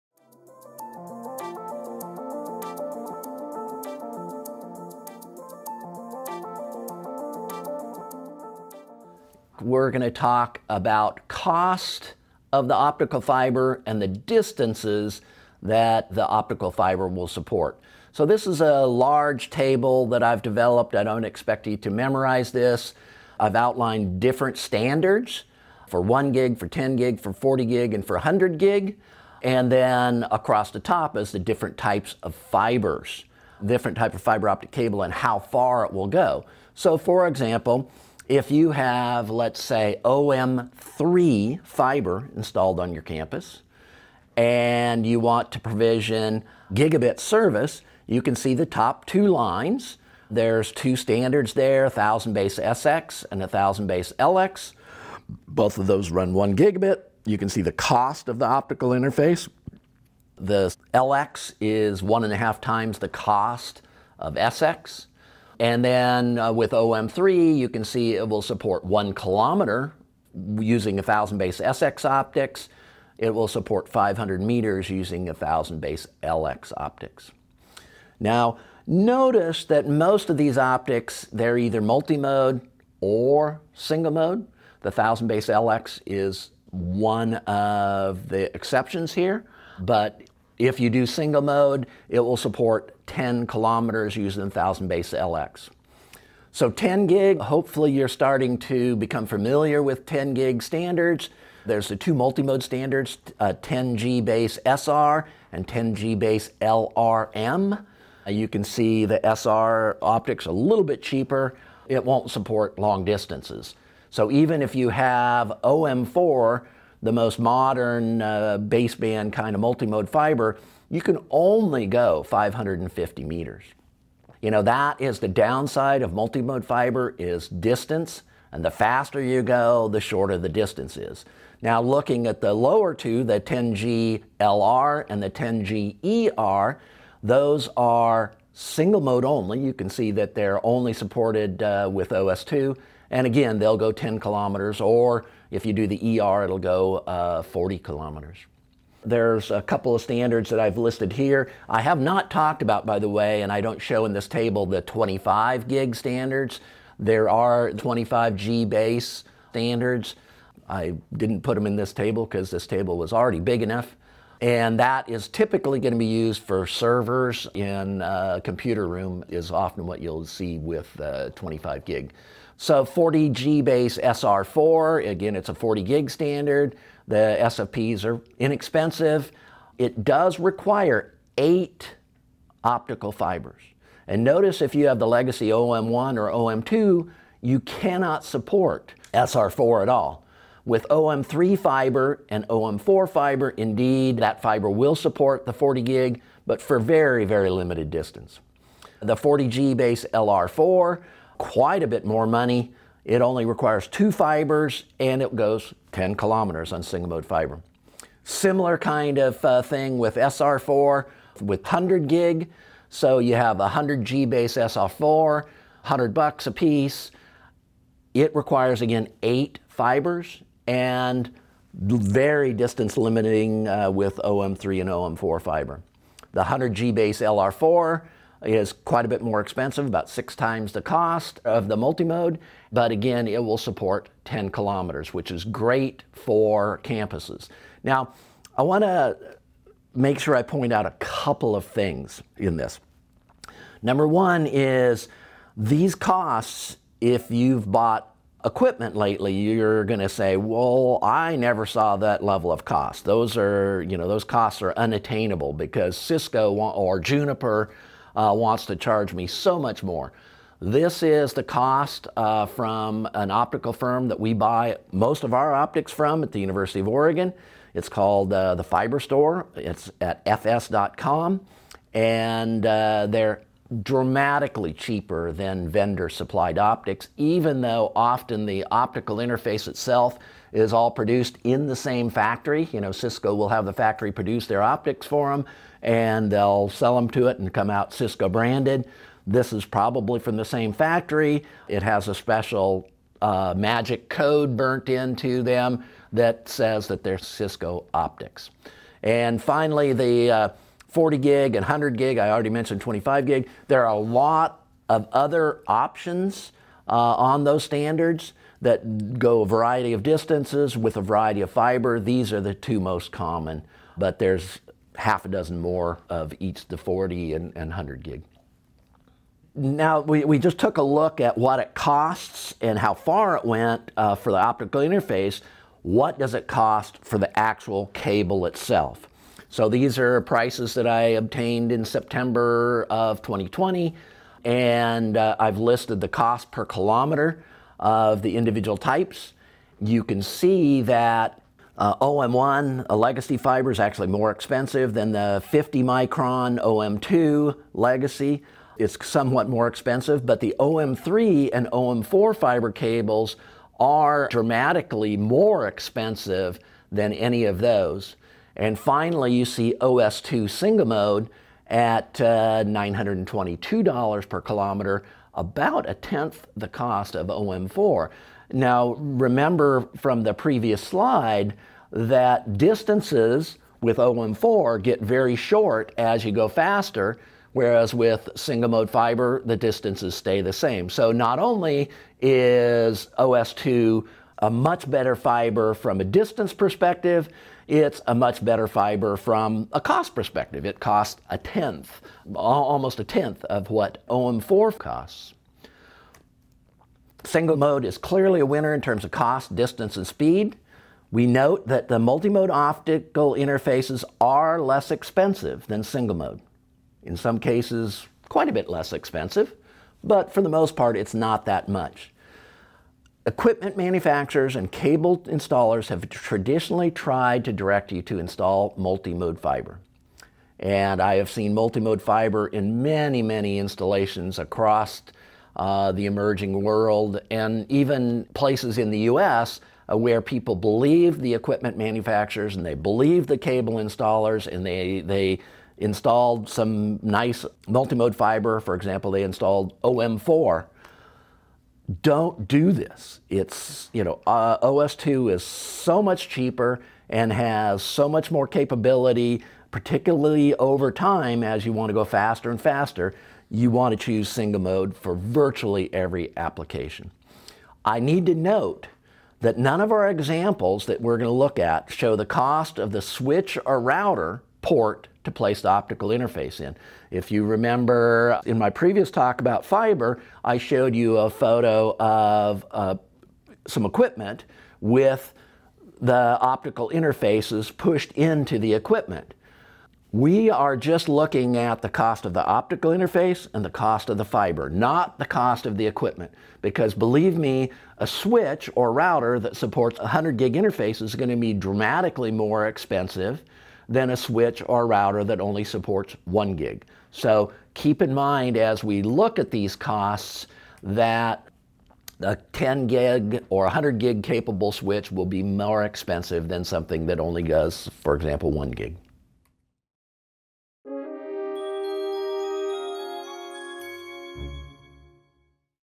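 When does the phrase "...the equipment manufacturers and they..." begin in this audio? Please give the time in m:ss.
7:11.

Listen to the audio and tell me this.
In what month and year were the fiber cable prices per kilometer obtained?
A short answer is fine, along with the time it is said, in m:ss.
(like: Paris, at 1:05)
September 2020, at 5:31.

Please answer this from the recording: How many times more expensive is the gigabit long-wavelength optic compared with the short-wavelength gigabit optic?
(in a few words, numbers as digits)
1.5 times.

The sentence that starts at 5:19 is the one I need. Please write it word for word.
Now, we, we just took a look at what it costs and how far it went uh, for the optical interface.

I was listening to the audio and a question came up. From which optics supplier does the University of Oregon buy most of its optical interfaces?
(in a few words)
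the Fiber Store.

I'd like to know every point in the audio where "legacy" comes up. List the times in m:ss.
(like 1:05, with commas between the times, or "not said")
3:05, 5:42, 5:47.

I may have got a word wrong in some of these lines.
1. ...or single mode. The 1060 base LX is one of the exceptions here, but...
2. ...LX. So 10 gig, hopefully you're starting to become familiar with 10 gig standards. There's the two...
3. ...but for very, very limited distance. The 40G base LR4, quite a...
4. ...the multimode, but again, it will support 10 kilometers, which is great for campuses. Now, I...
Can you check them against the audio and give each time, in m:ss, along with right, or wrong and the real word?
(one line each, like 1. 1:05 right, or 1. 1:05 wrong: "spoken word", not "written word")
1. 1:22 wrong: "1000", not "1060"
2. 1:35 right
3. 3:16 right
4. 3:51 right.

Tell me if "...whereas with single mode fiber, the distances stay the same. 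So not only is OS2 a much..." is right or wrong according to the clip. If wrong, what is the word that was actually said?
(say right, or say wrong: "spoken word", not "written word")
right.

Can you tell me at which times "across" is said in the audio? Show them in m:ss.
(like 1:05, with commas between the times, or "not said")
0:30, 7:04.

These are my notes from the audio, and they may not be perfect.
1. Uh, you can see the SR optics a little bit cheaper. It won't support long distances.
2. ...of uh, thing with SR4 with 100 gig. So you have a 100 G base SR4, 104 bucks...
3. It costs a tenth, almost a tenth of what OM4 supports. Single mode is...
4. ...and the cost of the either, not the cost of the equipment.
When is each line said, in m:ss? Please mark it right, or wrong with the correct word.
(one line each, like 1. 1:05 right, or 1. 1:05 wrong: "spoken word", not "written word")
1. 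1:48 right
2. 3:29 wrong: "100", not "104"
3. 6:30 wrong: "costs", not "supports"
4. 8:03 wrong: "fiber", not "either".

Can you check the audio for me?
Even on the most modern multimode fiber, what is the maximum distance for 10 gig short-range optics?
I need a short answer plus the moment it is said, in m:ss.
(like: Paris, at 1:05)
550 meters, at 2:02.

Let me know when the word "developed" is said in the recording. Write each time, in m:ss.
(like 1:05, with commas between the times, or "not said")
0:20.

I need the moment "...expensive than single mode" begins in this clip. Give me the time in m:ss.
6:44.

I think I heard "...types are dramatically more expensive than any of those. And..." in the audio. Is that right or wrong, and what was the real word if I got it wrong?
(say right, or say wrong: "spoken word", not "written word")
wrong: "cables", not "types".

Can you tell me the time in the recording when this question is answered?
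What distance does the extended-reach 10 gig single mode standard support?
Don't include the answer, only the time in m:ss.
2:27.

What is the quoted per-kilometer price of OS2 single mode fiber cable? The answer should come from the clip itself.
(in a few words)
$922.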